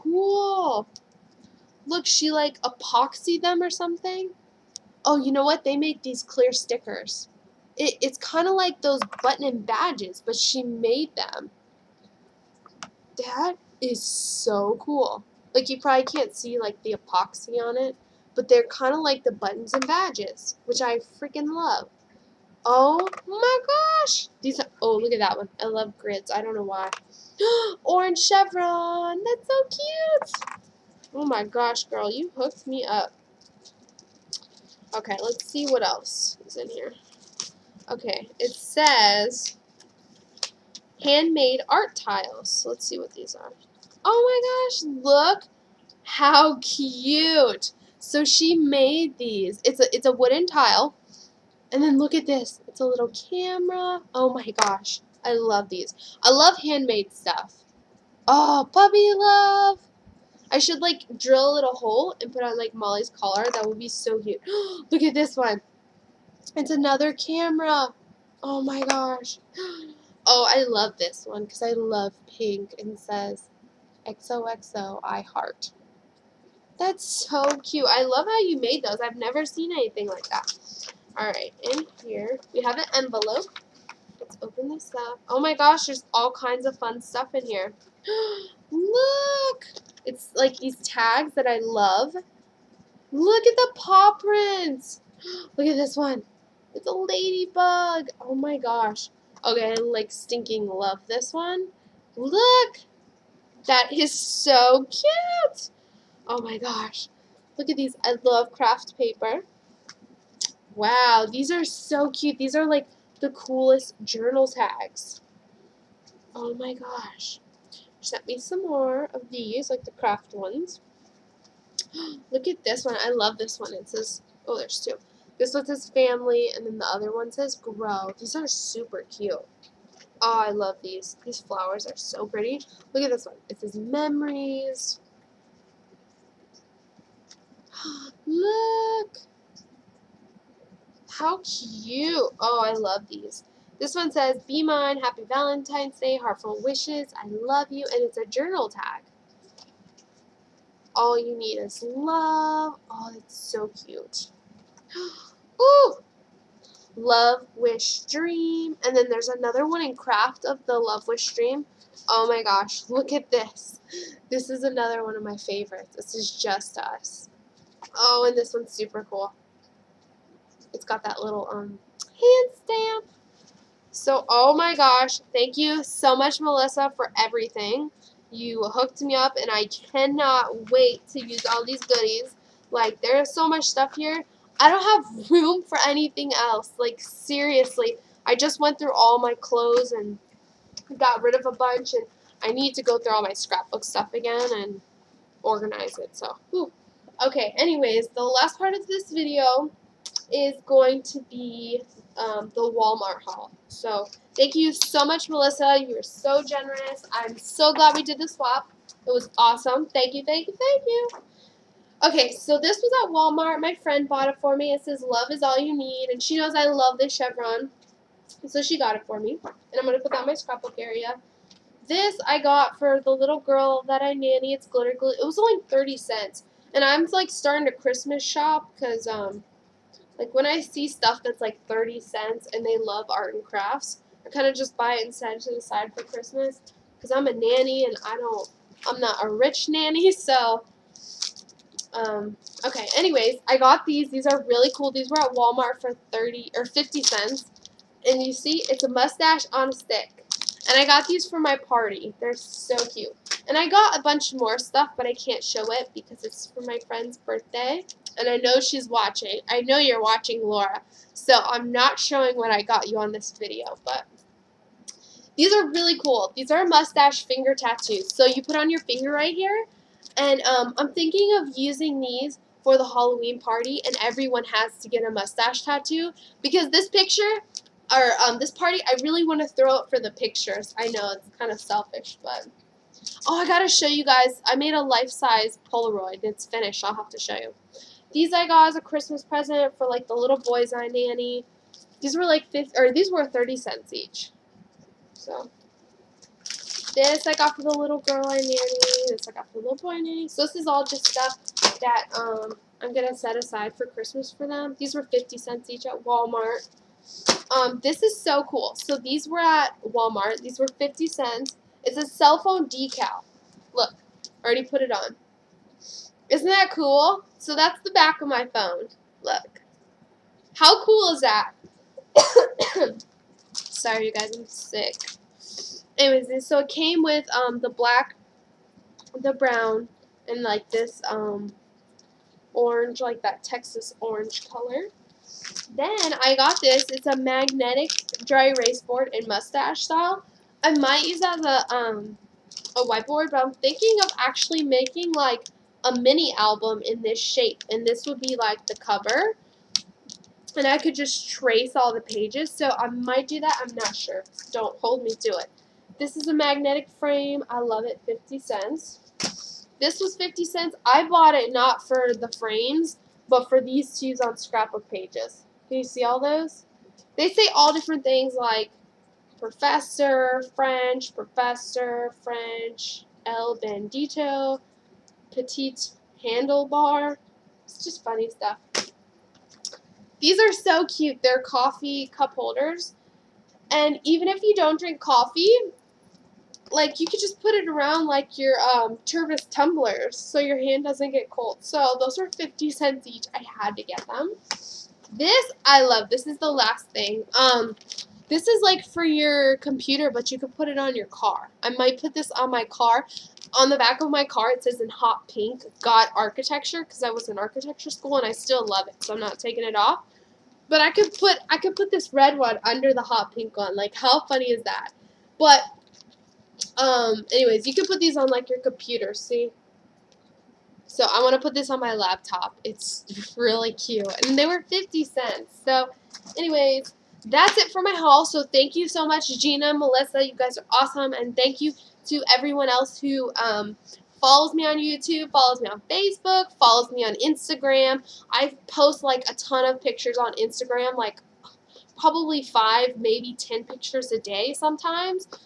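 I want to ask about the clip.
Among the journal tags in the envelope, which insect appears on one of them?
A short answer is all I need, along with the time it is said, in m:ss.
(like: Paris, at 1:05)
Ladybug, at 1:36.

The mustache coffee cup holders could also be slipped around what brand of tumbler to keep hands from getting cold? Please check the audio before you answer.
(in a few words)
Tervis.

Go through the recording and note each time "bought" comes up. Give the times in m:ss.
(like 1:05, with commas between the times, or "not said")
3:34, 6:01.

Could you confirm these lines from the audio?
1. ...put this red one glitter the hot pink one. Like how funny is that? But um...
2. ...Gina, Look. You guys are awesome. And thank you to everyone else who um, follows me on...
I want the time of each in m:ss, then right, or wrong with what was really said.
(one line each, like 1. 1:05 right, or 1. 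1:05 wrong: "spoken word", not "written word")
1. 6:51 wrong: "under", not "glitter"
2. 7:09 wrong: "Melissa", not "Look".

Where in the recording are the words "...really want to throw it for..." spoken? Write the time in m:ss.
4:39.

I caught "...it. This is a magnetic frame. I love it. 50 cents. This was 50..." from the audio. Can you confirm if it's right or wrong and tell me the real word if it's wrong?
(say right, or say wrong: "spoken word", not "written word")
right.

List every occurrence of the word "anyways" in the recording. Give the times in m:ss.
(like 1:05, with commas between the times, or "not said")
3:17, 4:02, 5:25, 6:57, 7:06.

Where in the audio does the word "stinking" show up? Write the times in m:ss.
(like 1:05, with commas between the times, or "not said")
1:40.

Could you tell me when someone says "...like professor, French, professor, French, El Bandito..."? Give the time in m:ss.
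6:08.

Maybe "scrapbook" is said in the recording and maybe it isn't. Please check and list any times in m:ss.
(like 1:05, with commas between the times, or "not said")
3:13, 3:40, 6:04.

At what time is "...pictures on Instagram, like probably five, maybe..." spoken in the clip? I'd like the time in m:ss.
7:19.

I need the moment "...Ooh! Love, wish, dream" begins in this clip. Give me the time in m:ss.
2:35.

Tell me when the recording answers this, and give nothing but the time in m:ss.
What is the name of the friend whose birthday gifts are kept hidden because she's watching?
4:20.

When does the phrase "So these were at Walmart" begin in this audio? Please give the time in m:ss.
5:08.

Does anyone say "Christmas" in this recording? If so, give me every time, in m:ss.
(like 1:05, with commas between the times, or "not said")
3:47, 3:56, 4:48, 5:03.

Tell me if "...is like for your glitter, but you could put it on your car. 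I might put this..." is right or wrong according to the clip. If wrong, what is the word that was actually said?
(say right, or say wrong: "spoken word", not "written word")
wrong: "computer", not "glitter".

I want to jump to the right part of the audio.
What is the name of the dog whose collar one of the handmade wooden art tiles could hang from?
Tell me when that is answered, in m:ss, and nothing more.
1:02.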